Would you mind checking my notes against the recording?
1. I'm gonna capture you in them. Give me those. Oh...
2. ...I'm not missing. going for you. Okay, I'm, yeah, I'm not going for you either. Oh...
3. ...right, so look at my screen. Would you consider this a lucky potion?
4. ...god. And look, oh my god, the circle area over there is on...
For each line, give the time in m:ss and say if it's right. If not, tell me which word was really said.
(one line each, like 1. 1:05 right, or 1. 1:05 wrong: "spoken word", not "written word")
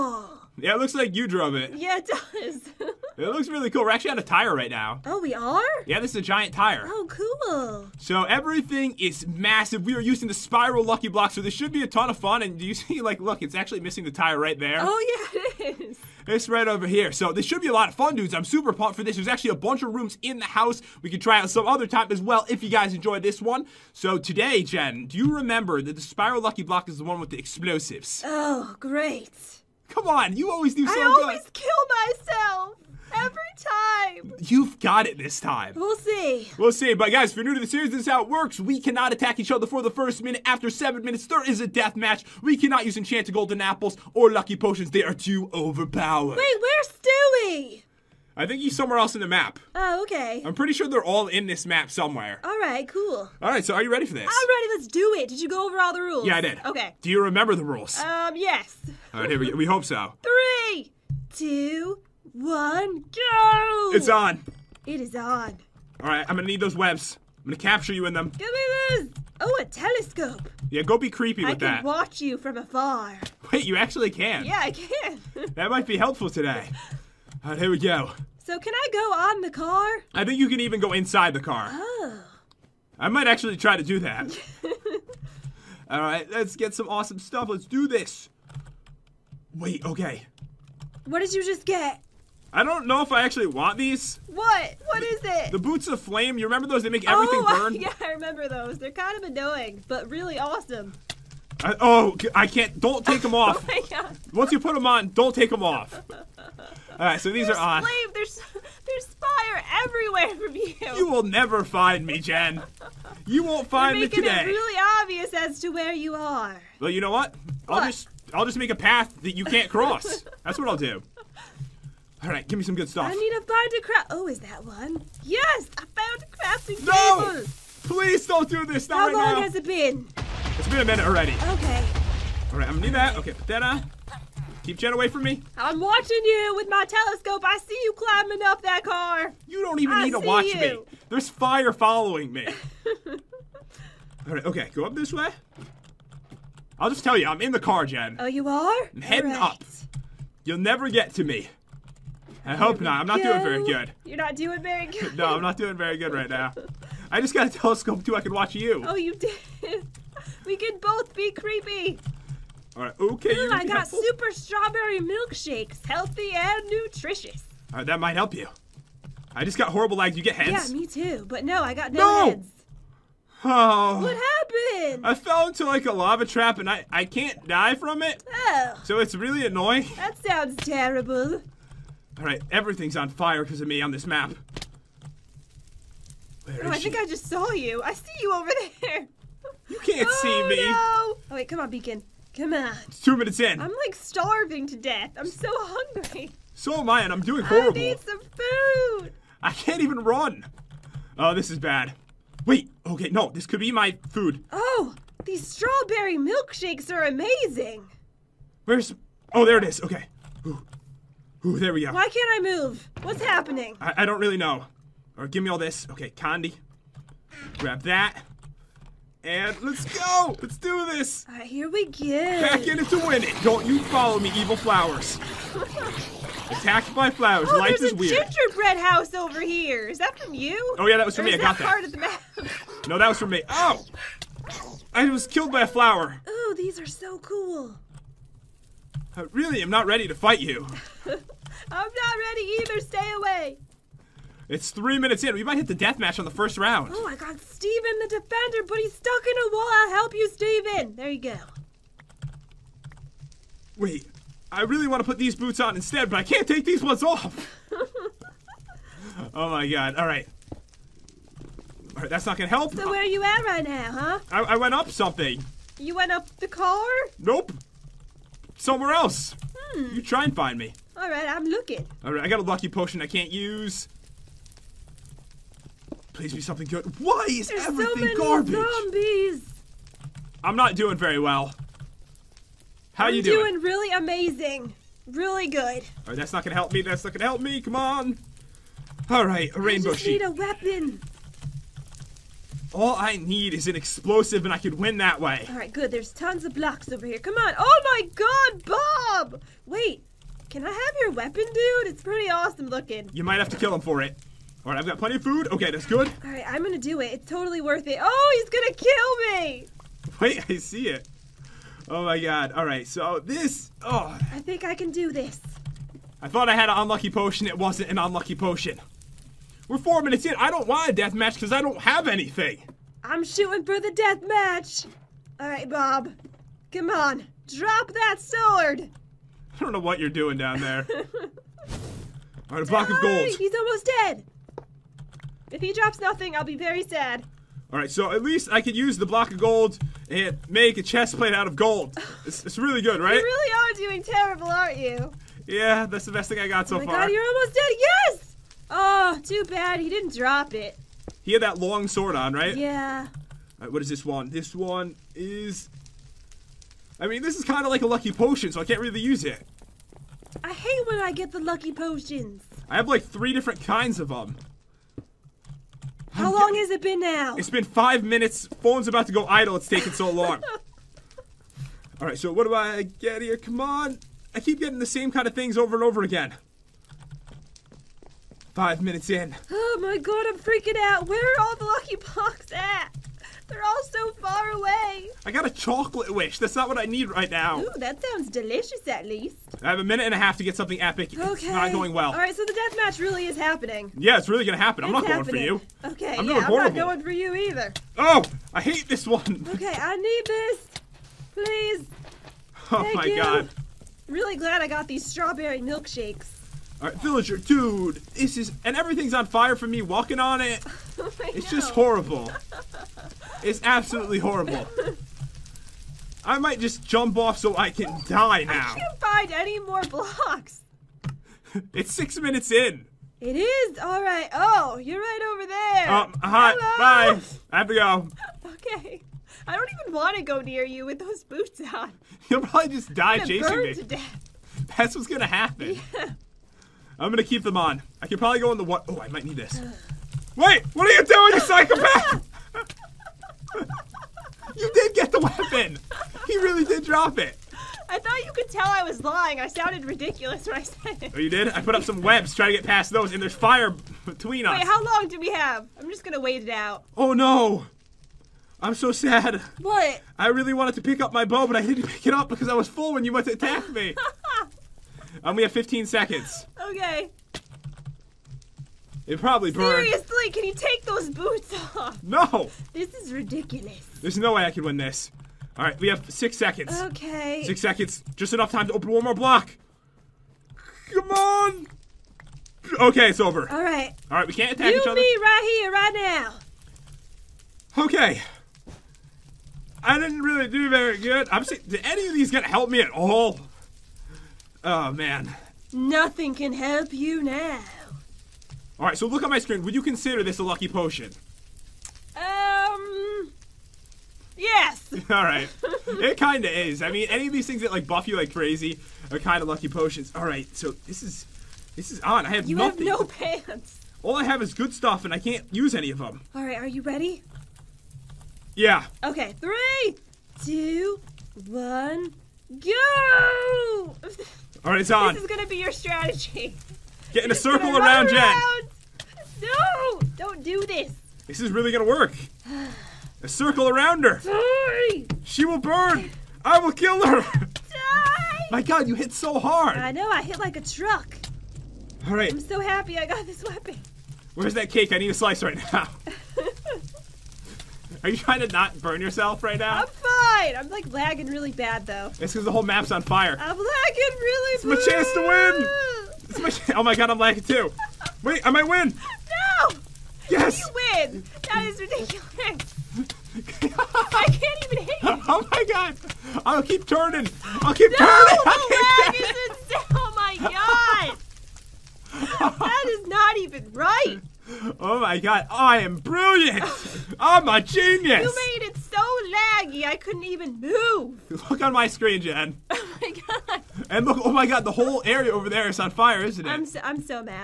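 1. 1:07 right
2. 6:34 wrong: "happening", not "missing"
3. 8:18 right
4. 9:43 wrong: "whole", not "circle".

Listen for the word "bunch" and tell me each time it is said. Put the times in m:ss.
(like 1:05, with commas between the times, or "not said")
0:19.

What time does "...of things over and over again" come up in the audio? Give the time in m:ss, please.
6:15.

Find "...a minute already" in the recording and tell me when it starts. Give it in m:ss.
2:10.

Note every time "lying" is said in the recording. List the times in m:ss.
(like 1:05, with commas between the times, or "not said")
7:29.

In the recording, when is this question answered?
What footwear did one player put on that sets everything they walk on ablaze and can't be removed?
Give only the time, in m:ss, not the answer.
1:35.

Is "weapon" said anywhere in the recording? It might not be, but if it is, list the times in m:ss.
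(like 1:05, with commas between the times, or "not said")
4:50, 5:01, 9:03.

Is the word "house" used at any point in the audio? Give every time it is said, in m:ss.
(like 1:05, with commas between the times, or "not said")
0:20, 3:48.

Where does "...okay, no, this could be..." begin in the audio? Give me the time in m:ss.
3:22.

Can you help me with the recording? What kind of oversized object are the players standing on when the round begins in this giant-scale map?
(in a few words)
A tire.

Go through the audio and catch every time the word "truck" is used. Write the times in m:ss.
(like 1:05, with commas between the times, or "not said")
9:00.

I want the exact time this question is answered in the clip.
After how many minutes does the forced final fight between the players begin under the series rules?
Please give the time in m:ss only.
0:40.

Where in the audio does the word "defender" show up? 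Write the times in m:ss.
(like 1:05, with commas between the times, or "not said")
4:08.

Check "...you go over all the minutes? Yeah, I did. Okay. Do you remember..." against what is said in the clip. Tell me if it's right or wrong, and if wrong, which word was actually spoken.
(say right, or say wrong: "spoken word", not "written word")
wrong: "rules", not "minutes".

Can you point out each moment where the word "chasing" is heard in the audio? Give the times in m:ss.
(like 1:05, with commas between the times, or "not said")
7:13.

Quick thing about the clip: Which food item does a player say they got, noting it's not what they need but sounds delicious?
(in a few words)
Chocolate wish.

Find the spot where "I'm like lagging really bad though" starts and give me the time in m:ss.
9:10.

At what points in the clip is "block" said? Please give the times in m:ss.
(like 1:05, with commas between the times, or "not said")
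0:11, 0:26, 4:56, 5:32, 5:39, 6:21, 6:59, 7:59.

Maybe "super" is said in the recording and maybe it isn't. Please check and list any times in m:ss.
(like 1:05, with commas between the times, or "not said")
0:18, 2:44.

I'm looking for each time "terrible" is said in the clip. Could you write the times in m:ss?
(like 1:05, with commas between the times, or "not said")
3:00, 5:44.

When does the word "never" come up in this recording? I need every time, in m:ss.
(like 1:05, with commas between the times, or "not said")
1:51, 2:30.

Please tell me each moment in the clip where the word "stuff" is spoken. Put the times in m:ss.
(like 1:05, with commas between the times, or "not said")
1:27, 2:02, 8:34.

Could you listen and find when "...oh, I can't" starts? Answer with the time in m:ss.
1:41.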